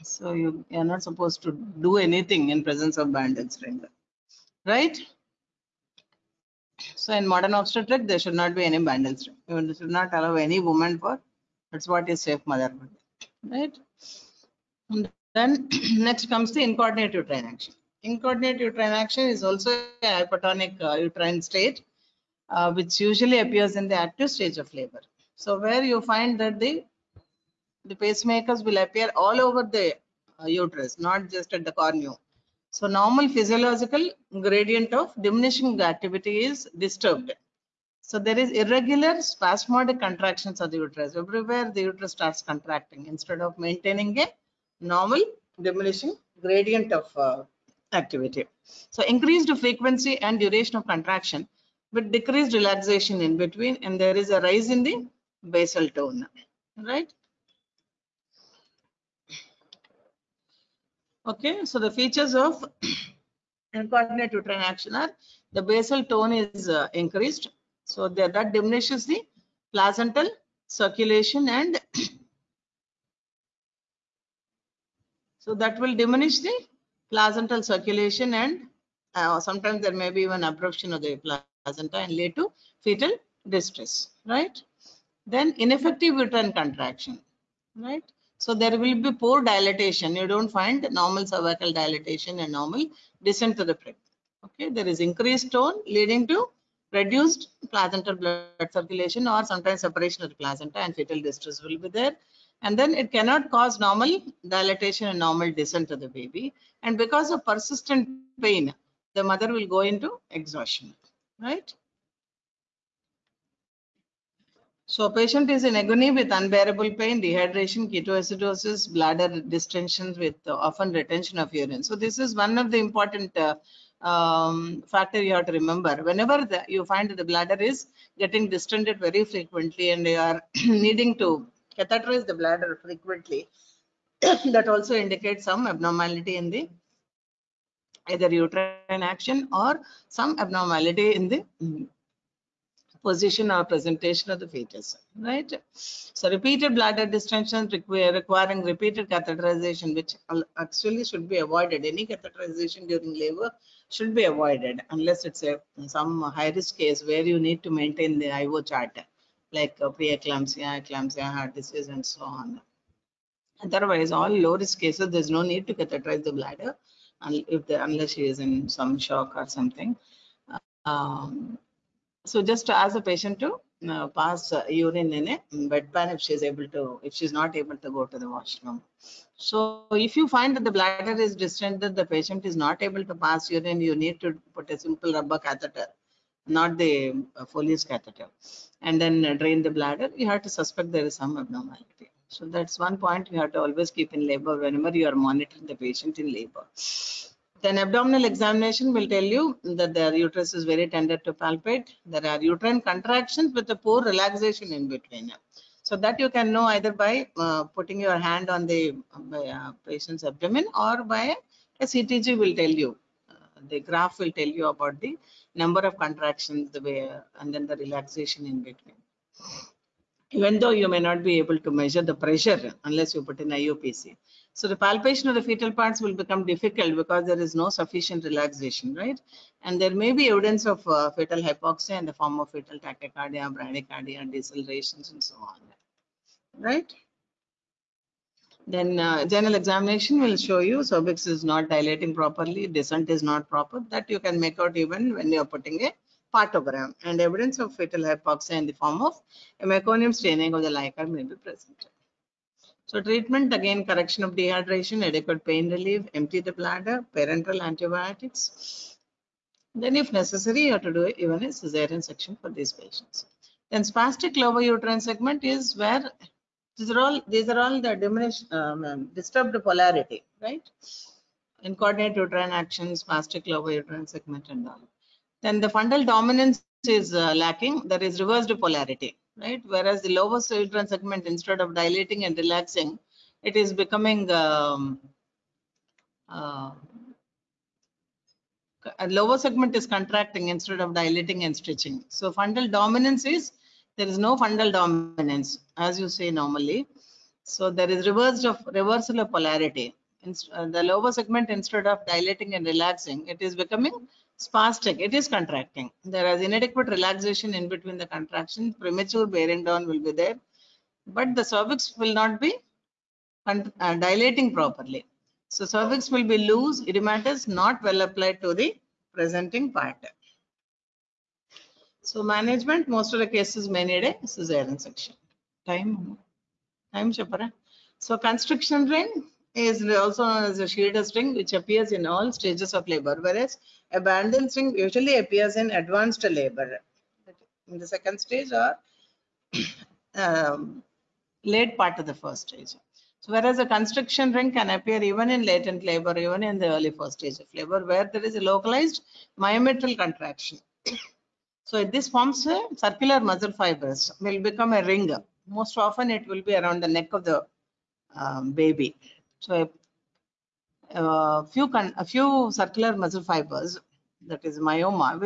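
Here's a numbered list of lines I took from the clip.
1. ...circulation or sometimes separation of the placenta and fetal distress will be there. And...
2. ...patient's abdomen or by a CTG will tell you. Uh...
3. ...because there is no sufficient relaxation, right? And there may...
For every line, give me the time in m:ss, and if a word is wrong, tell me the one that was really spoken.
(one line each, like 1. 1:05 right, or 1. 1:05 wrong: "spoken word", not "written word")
1. 1:38 right
2. 3:29 right
3. 3:47 right.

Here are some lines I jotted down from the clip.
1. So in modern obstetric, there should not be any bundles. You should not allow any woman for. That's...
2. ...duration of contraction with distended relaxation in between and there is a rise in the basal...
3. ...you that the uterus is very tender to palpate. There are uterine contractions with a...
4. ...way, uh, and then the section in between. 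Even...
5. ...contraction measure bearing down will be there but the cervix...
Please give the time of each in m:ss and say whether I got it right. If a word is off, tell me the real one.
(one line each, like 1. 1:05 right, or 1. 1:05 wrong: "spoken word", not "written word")
1. 0:06 right
2. 0:50 wrong: "decreased", not "distended"
3. 3:19 right
4. 3:36 wrong: "relaxation", not "section"
5. 5:08 wrong: "premature", not "measure".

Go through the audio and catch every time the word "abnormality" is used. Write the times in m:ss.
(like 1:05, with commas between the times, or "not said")
2:15, 2:20, 3:11.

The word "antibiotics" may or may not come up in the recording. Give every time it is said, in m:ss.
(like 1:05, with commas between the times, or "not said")
4:17.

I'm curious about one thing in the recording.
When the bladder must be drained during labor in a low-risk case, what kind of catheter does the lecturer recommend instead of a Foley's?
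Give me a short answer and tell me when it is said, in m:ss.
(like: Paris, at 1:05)
Simple rubber catheter, at 3:04.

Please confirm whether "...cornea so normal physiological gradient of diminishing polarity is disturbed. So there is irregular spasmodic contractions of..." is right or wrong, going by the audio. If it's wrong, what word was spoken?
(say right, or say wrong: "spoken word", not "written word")
wrong: "activity", not "polarity".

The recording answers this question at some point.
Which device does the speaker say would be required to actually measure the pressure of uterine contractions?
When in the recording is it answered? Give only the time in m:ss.
3:43.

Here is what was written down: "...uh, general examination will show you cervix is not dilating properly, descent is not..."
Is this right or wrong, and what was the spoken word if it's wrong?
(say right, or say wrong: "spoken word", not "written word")
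right.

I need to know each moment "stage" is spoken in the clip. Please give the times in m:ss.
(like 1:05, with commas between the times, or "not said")
0:24, 5:32, 5:38, 5:42, 5:47.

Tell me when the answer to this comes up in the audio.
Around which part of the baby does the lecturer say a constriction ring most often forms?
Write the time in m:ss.
5:56.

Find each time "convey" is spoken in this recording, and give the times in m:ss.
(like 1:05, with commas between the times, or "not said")
not said.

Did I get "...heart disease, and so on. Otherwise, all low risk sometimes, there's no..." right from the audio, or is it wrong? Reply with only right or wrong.
wrong.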